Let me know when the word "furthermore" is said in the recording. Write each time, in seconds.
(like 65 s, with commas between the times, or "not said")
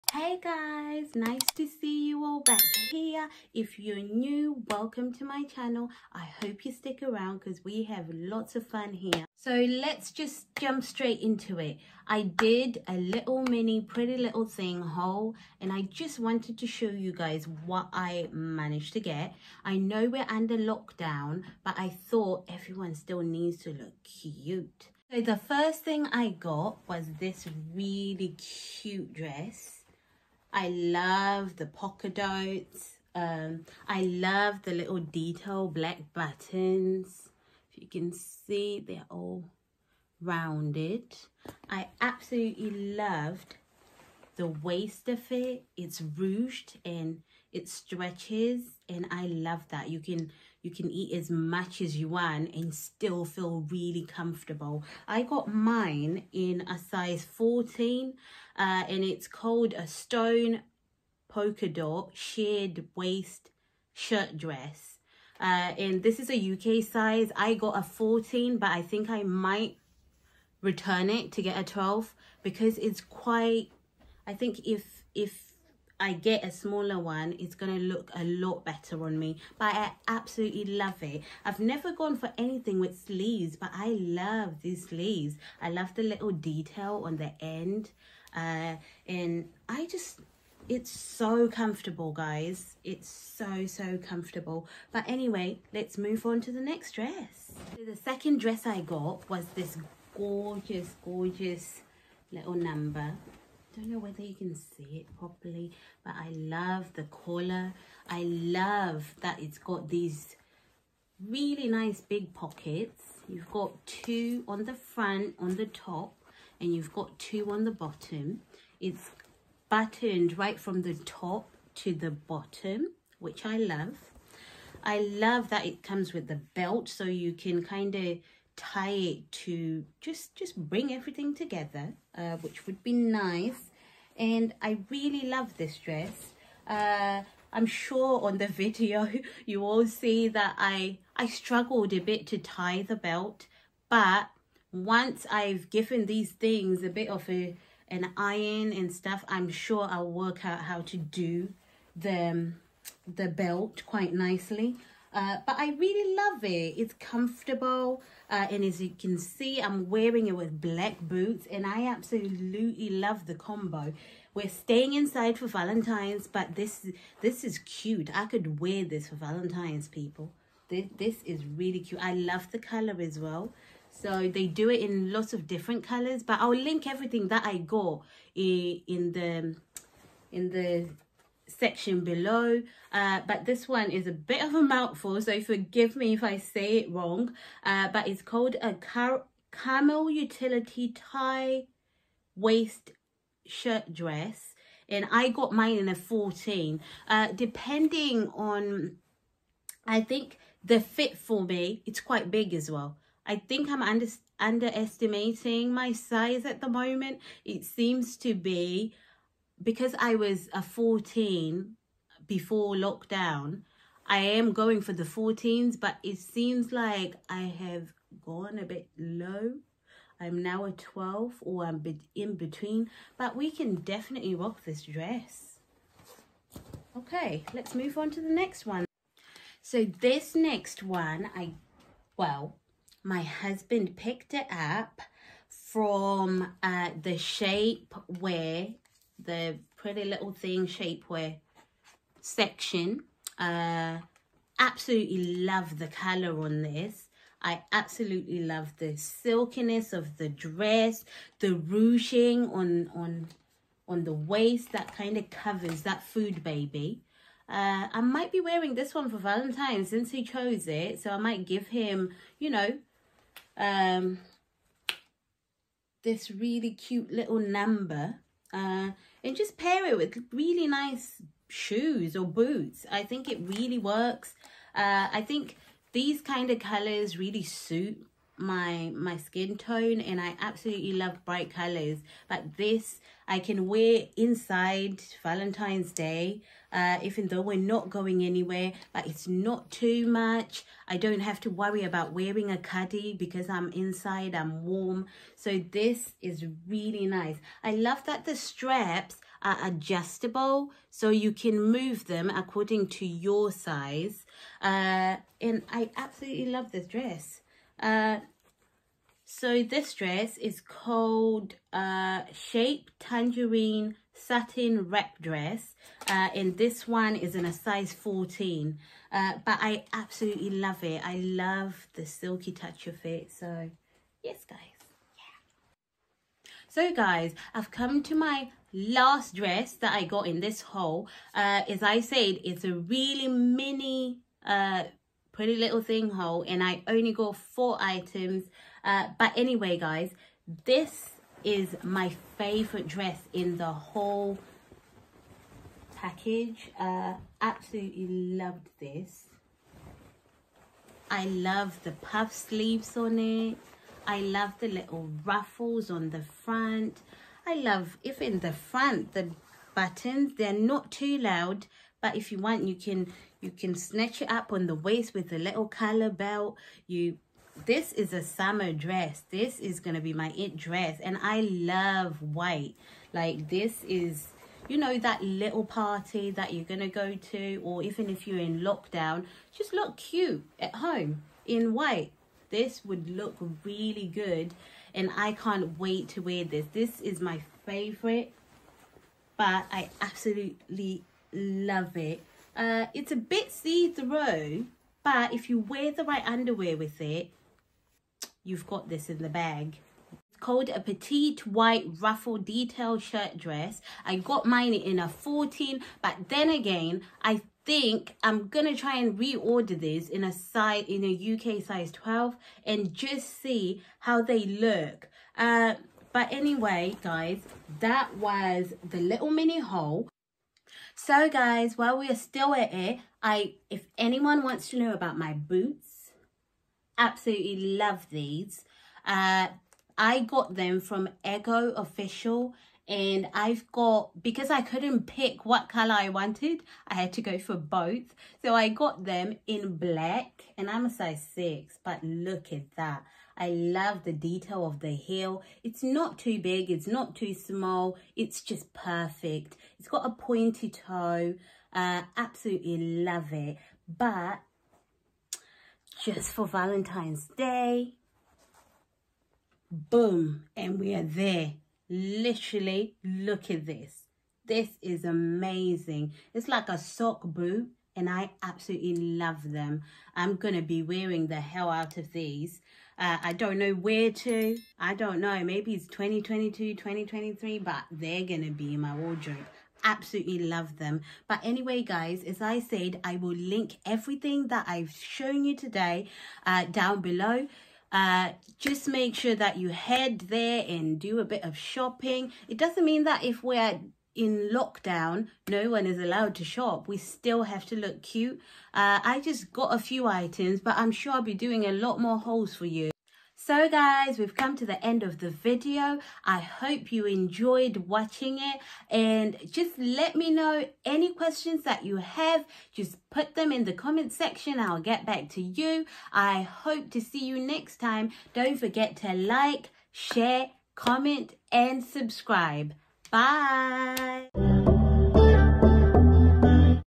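not said.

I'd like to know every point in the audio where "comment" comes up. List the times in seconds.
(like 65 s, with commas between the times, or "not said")
513 s, 520 s.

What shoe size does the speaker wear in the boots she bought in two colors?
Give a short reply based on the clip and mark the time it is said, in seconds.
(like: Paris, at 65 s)
6, at 440 s.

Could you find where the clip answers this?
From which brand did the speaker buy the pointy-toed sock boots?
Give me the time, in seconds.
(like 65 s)
431 s.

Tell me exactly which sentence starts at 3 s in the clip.
If you're new, welcome to my channel.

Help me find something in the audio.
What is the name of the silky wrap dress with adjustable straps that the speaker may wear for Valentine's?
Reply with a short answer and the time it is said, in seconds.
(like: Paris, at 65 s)
Shape Tangerine Satin Wrap Dress, at 312 s.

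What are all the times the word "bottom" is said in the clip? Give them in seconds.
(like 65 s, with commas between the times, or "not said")
117 s, 122 s.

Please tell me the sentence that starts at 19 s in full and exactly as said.
I know we're under lockdown, but I thought everyone still needs to look cute.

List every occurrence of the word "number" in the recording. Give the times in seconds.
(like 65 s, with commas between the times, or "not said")
102 s, 267 s.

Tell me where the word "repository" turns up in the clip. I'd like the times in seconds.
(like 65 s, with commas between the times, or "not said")
not said.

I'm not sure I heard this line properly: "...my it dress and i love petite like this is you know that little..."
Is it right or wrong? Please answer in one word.
wrong.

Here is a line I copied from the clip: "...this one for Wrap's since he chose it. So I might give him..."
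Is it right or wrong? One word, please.
wrong.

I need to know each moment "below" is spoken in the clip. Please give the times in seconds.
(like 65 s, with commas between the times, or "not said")
182 s, 487 s.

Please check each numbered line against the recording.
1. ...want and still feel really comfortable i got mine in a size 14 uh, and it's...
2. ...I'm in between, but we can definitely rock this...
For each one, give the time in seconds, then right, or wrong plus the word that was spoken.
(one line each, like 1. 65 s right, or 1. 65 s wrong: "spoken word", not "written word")
1. 52 s right
2. 221 s right.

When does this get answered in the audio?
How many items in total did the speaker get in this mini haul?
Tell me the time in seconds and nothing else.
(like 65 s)
337 s.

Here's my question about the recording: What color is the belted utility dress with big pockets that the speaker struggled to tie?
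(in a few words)
Camel.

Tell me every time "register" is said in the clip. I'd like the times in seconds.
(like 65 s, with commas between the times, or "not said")
not said.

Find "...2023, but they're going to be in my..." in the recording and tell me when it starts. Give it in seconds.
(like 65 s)
476 s.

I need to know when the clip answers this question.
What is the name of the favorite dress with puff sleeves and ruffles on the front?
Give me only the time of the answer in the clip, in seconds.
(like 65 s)
400 s.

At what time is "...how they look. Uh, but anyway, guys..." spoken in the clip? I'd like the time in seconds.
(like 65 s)
413 s.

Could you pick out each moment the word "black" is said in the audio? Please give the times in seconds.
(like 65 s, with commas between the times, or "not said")
35 s, 160 s, 439 s.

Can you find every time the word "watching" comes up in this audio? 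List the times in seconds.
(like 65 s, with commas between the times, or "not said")
507 s.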